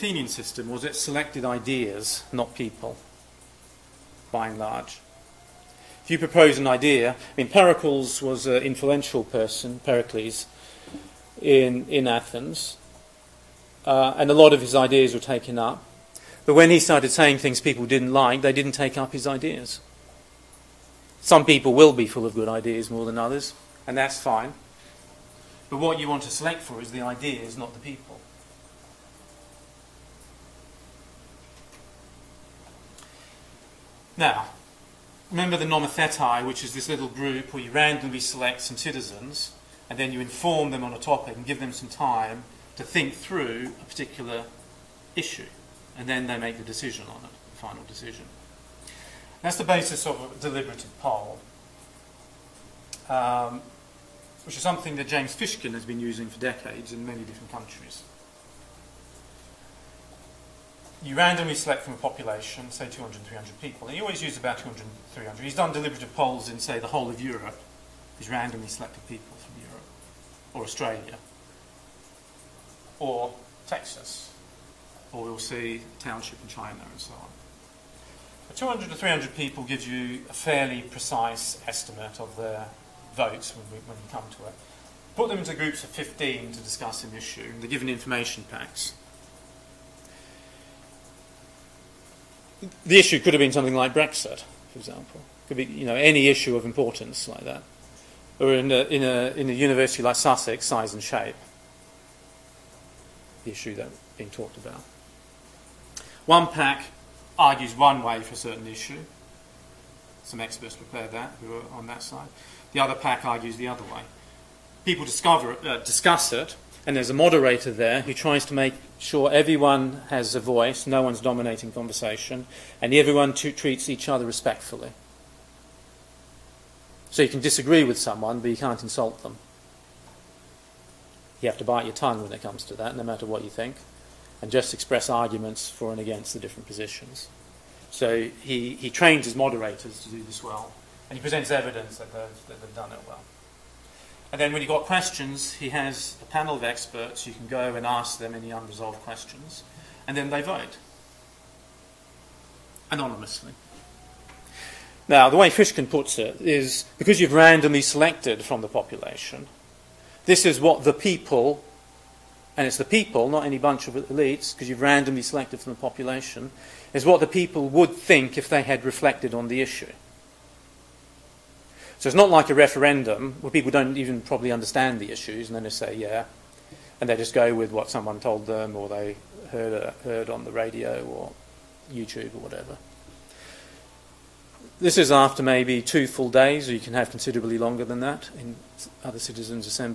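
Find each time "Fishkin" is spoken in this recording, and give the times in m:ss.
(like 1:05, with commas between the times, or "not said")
0:55, 2:35.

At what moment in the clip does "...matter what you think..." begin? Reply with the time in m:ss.
2:13.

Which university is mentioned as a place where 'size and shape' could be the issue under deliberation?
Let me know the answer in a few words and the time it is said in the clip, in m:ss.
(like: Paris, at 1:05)
Sussex, at 1:40.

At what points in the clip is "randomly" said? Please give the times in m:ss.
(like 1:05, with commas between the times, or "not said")
0:37, 1:01, 1:08, 2:37, 2:44.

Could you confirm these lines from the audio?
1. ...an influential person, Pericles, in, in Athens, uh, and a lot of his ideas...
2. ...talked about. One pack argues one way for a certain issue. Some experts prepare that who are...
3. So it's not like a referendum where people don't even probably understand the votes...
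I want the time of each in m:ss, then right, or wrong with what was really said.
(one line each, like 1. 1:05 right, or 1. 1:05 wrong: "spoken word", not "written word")
1. 0:08 right
2. 1:44 right
3. 2:52 wrong: "issues", not "votes".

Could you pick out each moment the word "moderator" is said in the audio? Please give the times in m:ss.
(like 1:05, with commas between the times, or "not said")
1:57, 2:19.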